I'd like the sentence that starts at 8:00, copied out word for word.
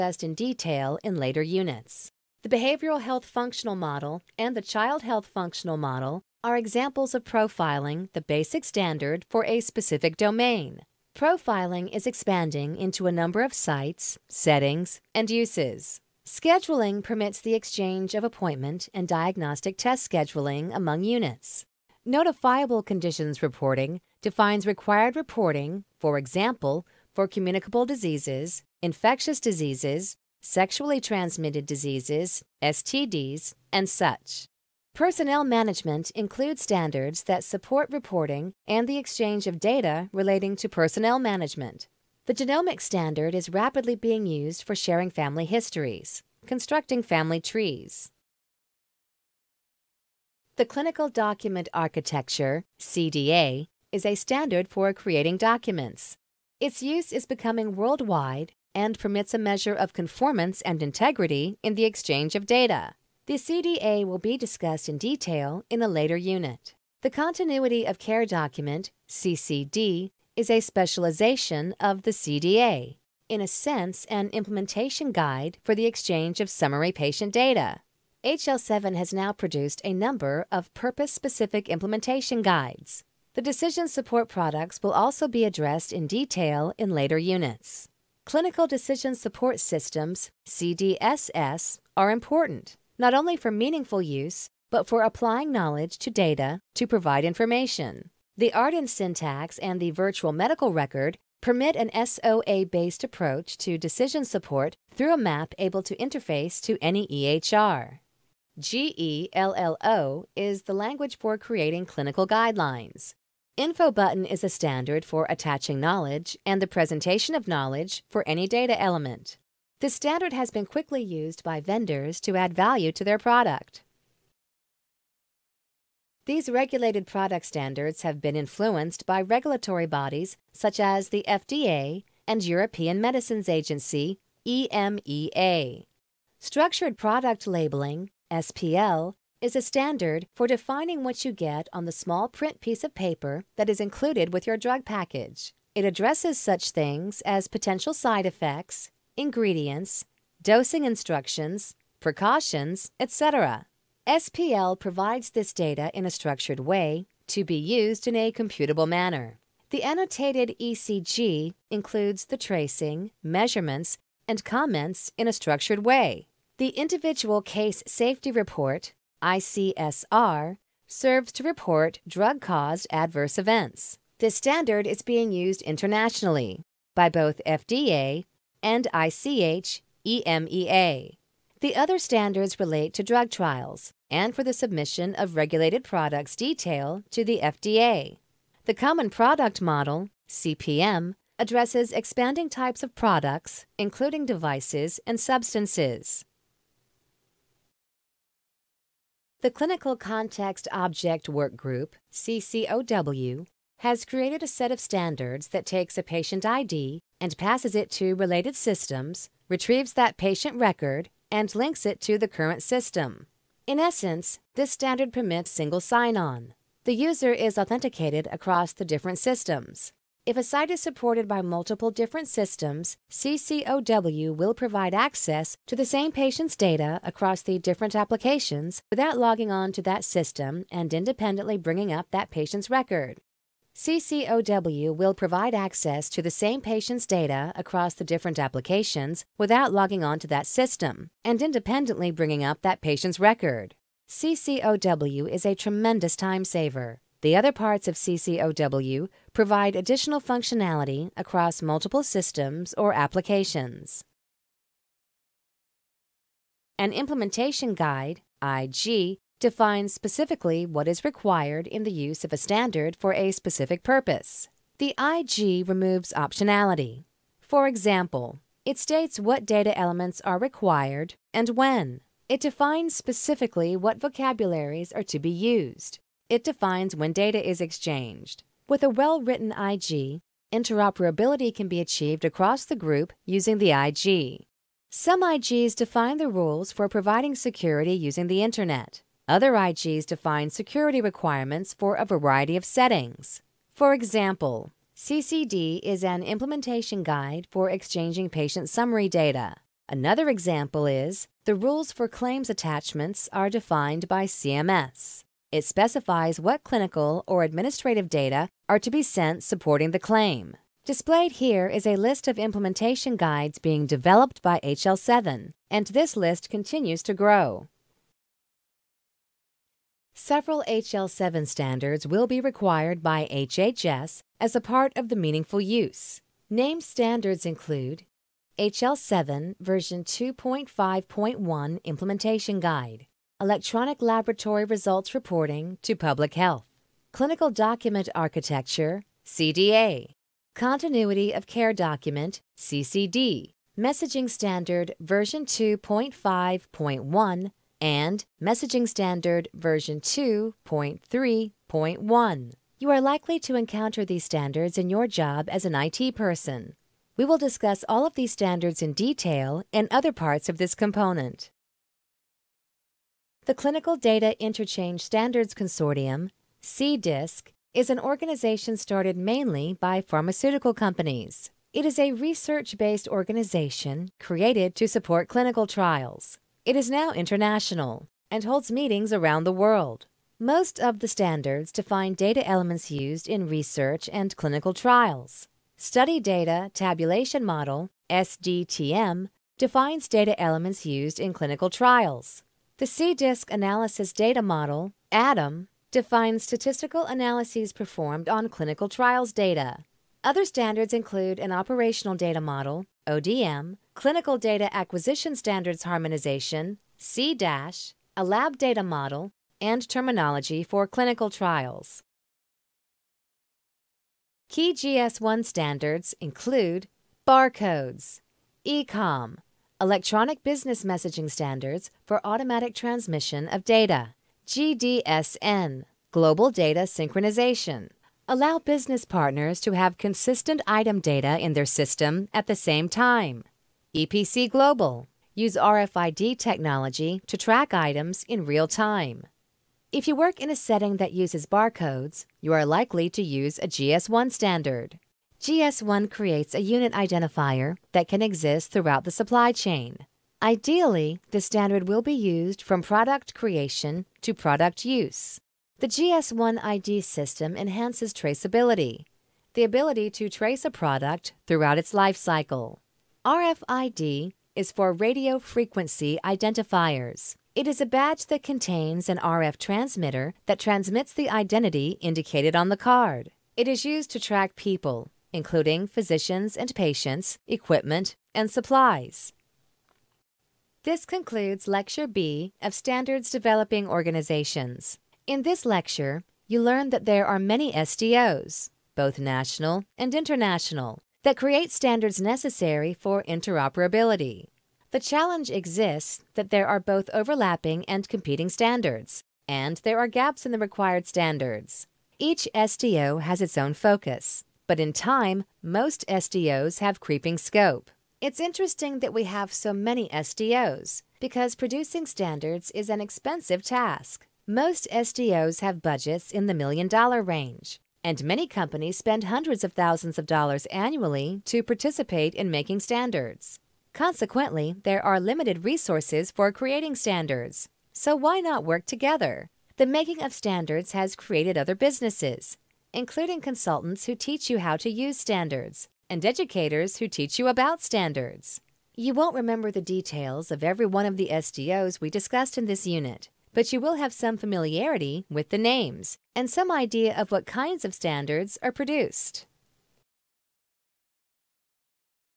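This concludes Lecture B of Standards Developing Organizations.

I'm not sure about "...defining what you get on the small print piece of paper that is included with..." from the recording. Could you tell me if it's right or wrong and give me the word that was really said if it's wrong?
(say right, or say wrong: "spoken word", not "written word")
right.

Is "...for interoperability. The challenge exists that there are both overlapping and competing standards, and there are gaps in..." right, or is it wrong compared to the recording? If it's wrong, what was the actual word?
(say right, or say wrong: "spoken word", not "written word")
right.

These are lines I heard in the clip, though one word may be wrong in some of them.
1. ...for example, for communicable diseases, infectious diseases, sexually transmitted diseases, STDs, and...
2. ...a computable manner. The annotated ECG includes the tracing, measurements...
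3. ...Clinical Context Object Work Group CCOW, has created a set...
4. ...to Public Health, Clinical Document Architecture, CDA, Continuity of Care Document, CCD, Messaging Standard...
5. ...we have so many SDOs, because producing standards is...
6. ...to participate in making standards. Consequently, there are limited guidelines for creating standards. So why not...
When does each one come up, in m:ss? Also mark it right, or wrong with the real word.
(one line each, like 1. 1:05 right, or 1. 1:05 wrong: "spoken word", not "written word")
1. 0:25 right
2. 2:38 right
3. 3:19 right
4. 5:35 right
5. 8:29 right
6. 8:41 wrong: "resources", not "guidelines".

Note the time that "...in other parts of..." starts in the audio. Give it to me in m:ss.
5:59.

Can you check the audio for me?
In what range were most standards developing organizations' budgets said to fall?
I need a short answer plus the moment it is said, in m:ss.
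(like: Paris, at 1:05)
Million dollar range, at 8:36.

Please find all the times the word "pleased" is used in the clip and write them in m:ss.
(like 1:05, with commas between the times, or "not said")
not said.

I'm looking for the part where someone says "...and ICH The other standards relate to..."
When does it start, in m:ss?
2:58.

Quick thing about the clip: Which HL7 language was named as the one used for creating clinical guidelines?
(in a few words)
GELLO.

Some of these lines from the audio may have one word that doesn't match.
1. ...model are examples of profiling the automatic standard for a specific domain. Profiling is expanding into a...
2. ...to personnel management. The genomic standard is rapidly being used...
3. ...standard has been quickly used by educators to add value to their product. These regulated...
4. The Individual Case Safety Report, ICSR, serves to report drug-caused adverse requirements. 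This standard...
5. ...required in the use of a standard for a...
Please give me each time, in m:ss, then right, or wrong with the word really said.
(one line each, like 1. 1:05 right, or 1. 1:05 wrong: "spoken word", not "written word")
1. 0:05 wrong: "basic", not "automatic"
2. 0:40 right
3. 1:59 wrong: "vendors", not "educators"
4. 2:46 wrong: "events", not "requirements"
5. 4:21 right.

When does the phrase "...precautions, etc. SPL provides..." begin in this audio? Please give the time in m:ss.
2:32.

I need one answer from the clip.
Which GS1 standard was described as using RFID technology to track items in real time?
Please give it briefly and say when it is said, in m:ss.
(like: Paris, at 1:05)
EPC Global, at 7:13.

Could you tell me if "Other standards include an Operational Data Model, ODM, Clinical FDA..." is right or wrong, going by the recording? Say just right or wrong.
wrong.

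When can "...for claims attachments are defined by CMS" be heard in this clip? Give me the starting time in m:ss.
5:01.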